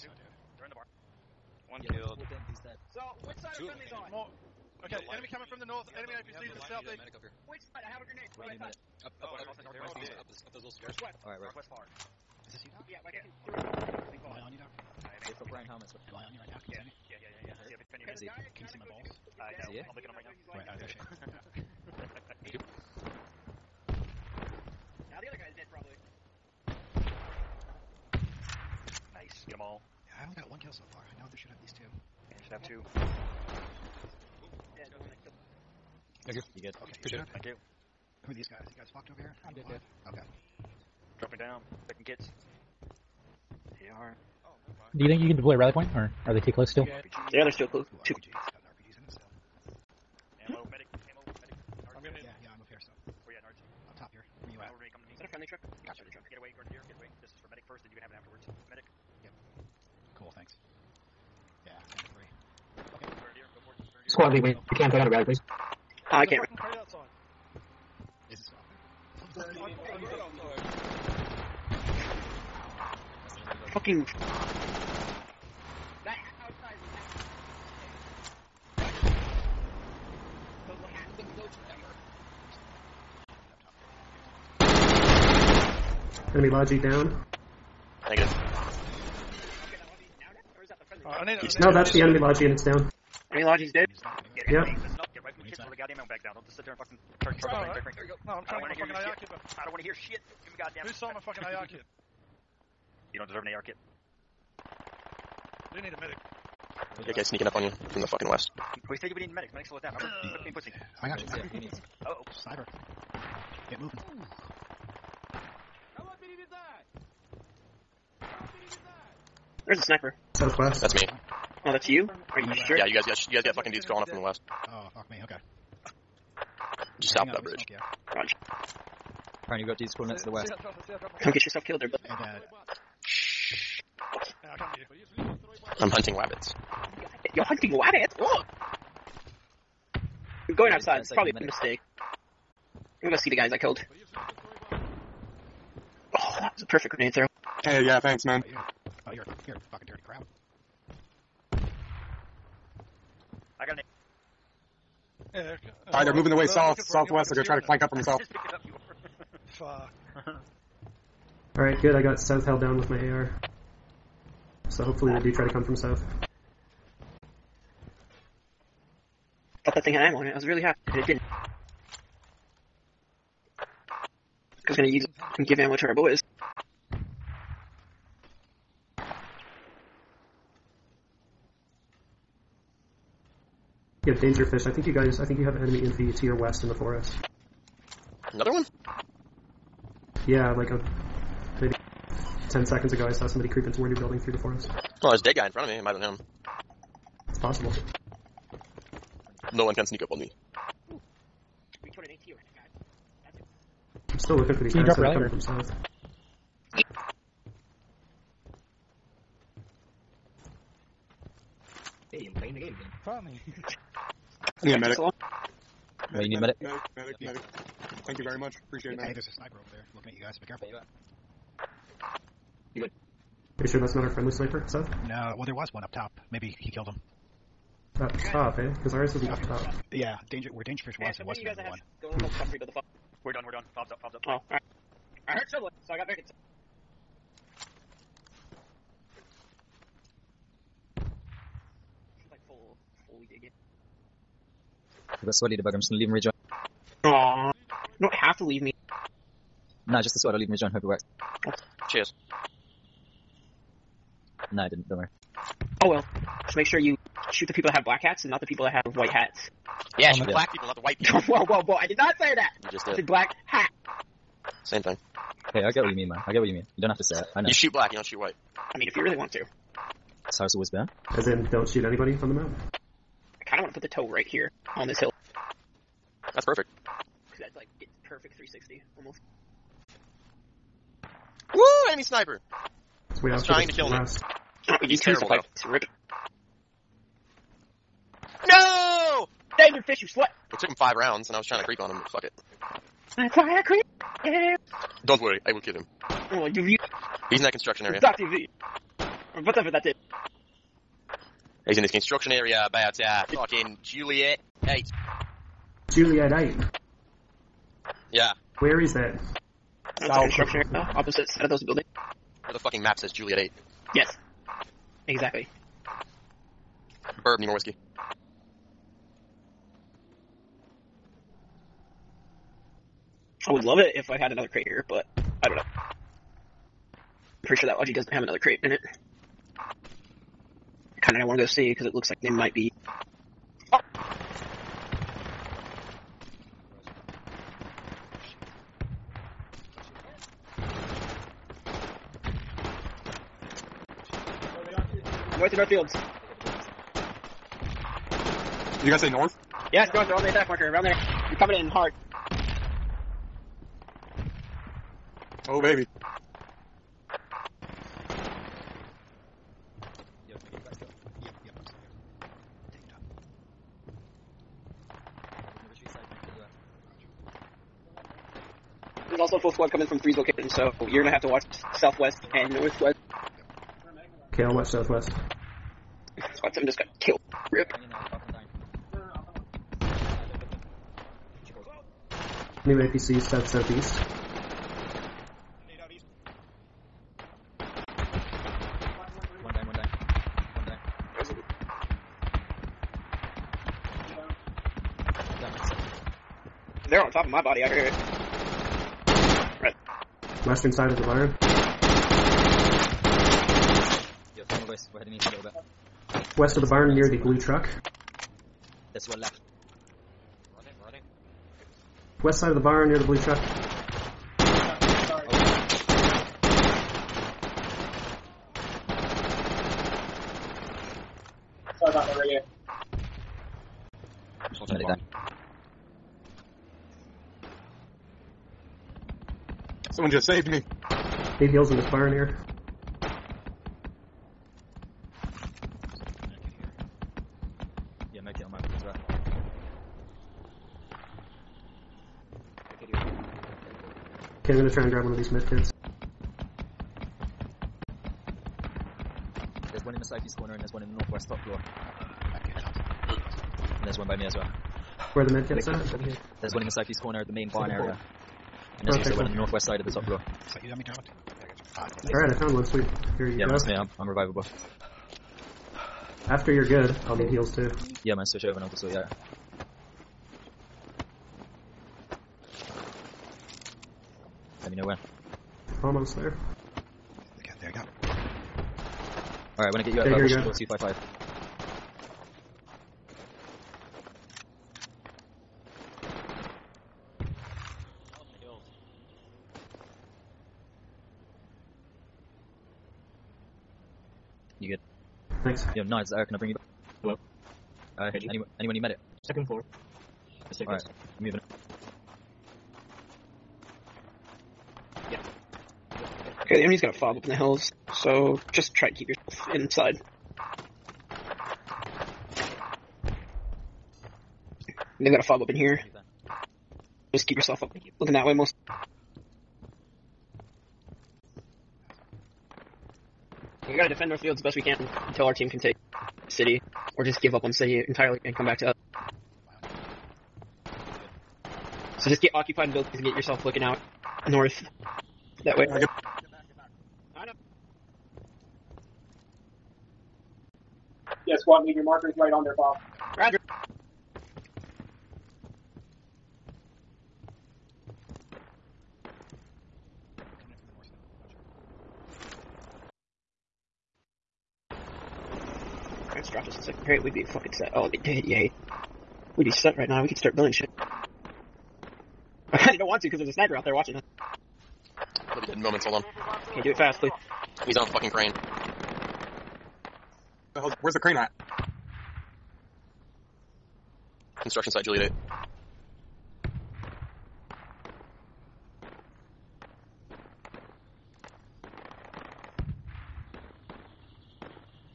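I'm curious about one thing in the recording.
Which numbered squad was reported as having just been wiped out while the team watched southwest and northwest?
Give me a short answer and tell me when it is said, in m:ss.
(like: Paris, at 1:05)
Squad 7, at 6:16.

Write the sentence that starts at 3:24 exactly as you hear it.
I'm still looking for these Can you guys drop that are coming from south.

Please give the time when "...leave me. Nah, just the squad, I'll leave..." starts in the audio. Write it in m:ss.
4:08.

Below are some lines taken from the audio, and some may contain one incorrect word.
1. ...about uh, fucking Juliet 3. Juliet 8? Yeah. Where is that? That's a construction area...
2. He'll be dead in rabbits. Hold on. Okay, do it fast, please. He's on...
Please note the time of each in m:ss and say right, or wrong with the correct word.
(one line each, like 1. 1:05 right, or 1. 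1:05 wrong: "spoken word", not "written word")
1. 5:02 wrong: "8", not "3"
2. 9:25 wrong: "moments", not "rabbits".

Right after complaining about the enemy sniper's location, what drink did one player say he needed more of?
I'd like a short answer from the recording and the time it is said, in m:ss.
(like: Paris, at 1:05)
whiskey, at 5:17.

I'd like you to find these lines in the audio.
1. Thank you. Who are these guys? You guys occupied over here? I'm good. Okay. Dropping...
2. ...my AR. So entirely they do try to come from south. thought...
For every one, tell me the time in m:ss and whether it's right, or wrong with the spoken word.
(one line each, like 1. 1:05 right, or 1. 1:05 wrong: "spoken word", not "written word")
1. 0:37 wrong: "fucked", not "occupied"
2. 2:42 wrong: "hopefully", not "entirely".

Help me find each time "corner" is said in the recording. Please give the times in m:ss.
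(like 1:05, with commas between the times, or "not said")
7:30, 7:36.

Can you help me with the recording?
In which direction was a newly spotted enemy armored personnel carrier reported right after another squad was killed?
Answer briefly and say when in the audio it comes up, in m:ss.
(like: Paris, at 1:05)
south southeast, at 6:23.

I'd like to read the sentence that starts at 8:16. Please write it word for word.
uh, can I bring you back?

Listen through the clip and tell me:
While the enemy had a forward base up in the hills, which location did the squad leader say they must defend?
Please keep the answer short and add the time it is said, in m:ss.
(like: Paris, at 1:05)
Northfield, at 8:44.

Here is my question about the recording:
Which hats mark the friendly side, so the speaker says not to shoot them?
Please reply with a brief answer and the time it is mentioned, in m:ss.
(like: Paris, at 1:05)
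white hats, at 4:18.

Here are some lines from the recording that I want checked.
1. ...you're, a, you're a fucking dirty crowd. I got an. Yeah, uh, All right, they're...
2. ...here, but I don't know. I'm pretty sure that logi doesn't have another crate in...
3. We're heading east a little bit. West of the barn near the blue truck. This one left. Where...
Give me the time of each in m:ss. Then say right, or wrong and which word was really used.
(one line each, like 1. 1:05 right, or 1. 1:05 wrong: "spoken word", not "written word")
1. 2:29 right
2. 5:24 right
3. 6:44 right.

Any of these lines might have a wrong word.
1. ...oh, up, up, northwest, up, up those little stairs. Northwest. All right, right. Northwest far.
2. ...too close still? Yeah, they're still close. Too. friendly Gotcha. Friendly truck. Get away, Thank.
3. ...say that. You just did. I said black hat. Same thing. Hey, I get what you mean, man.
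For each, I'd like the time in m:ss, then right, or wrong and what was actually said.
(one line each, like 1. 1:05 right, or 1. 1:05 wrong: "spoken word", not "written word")
1. 0:09 right
2. 0:46 wrong: "Grenadier", not "Thank"
3. 4:22 right.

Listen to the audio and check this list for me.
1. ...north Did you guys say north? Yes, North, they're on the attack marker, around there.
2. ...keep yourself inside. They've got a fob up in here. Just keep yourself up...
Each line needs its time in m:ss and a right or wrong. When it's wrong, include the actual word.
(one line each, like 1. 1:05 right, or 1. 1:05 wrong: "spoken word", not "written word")
1. 5:45 right
2. 8:28 right.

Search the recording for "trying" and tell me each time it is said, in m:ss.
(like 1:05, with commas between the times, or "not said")
1:38, 4:43, 4:51.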